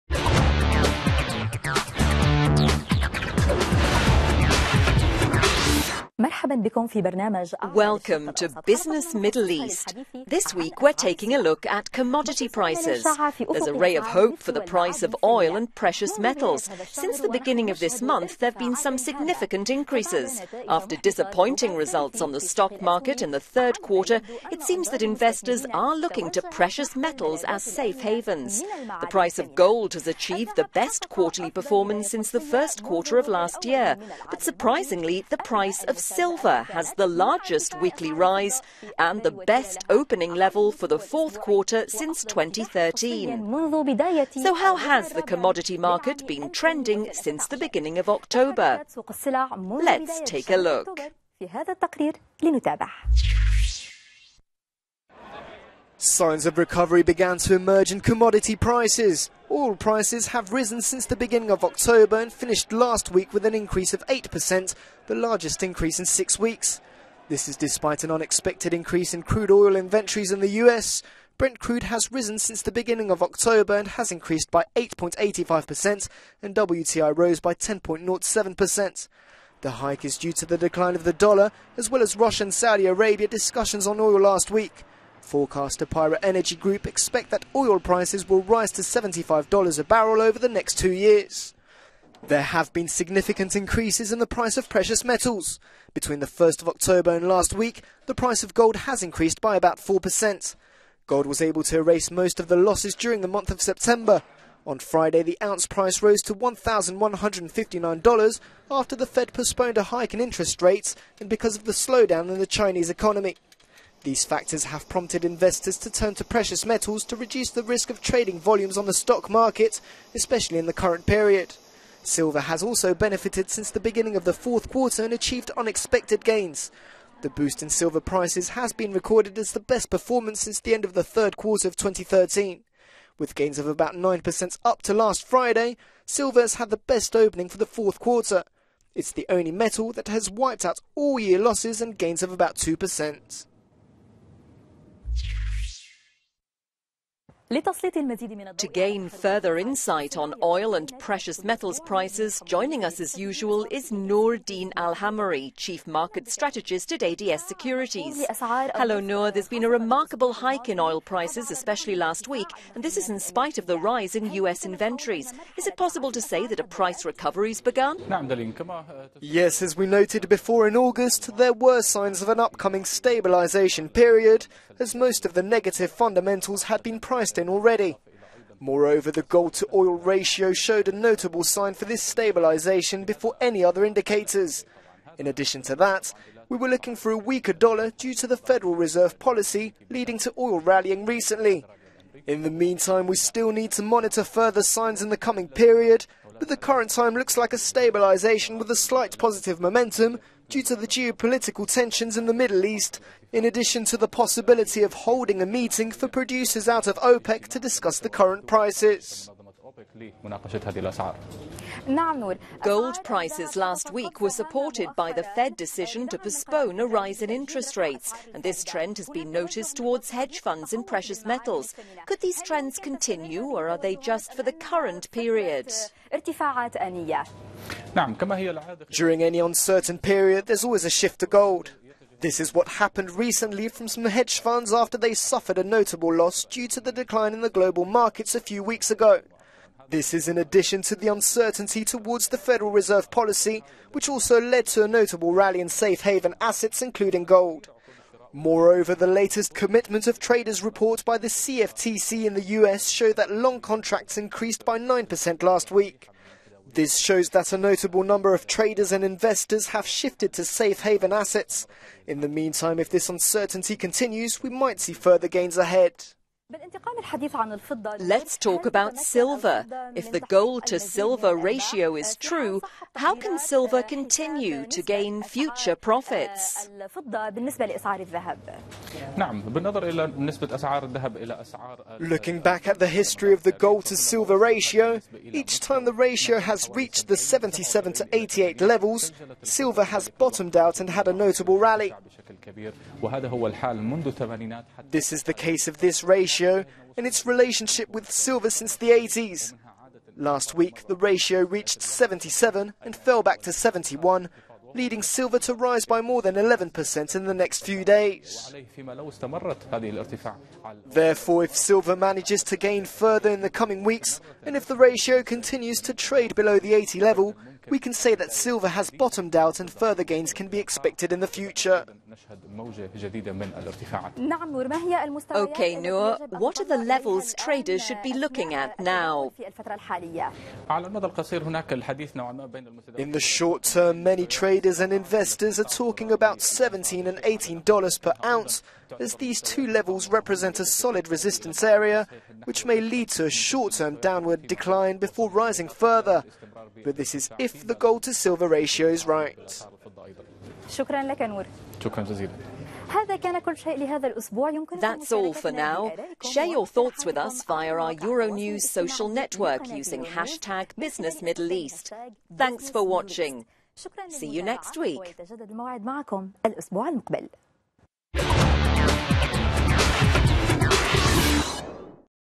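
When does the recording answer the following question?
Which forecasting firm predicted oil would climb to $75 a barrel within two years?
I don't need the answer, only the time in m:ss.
1:25.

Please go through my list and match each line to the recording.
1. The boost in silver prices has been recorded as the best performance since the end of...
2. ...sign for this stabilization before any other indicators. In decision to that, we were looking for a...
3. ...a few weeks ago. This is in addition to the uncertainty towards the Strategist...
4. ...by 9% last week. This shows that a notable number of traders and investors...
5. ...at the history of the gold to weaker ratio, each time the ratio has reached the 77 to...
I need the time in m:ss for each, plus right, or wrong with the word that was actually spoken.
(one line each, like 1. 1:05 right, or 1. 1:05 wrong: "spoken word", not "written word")
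1. 2:07 right
2. 3:01 wrong: "addition", not "decision"
3. 3:58 wrong: "Federal", not "Strategist"
4. 4:14 right
5. 4:42 wrong: "silver", not "weaker".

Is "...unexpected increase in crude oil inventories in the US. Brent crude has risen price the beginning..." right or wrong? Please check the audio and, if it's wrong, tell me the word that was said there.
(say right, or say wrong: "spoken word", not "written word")
wrong: "since", not "price".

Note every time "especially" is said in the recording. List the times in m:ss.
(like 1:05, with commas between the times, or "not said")
2:00, 2:41.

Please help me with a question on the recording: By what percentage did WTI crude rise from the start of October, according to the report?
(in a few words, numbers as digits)
10.07%.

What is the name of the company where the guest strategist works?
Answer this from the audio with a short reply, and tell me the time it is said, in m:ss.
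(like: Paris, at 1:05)
ADS Securities, at 2:37.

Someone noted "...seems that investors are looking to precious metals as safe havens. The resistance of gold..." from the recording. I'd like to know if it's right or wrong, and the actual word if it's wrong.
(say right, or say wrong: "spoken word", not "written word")
wrong: "price", not "resistance".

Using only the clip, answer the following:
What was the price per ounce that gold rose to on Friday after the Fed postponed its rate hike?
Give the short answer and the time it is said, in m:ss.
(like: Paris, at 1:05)
$1,159, at 1:46.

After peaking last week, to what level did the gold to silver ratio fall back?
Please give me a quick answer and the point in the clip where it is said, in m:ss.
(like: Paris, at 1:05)
71, at 5:03.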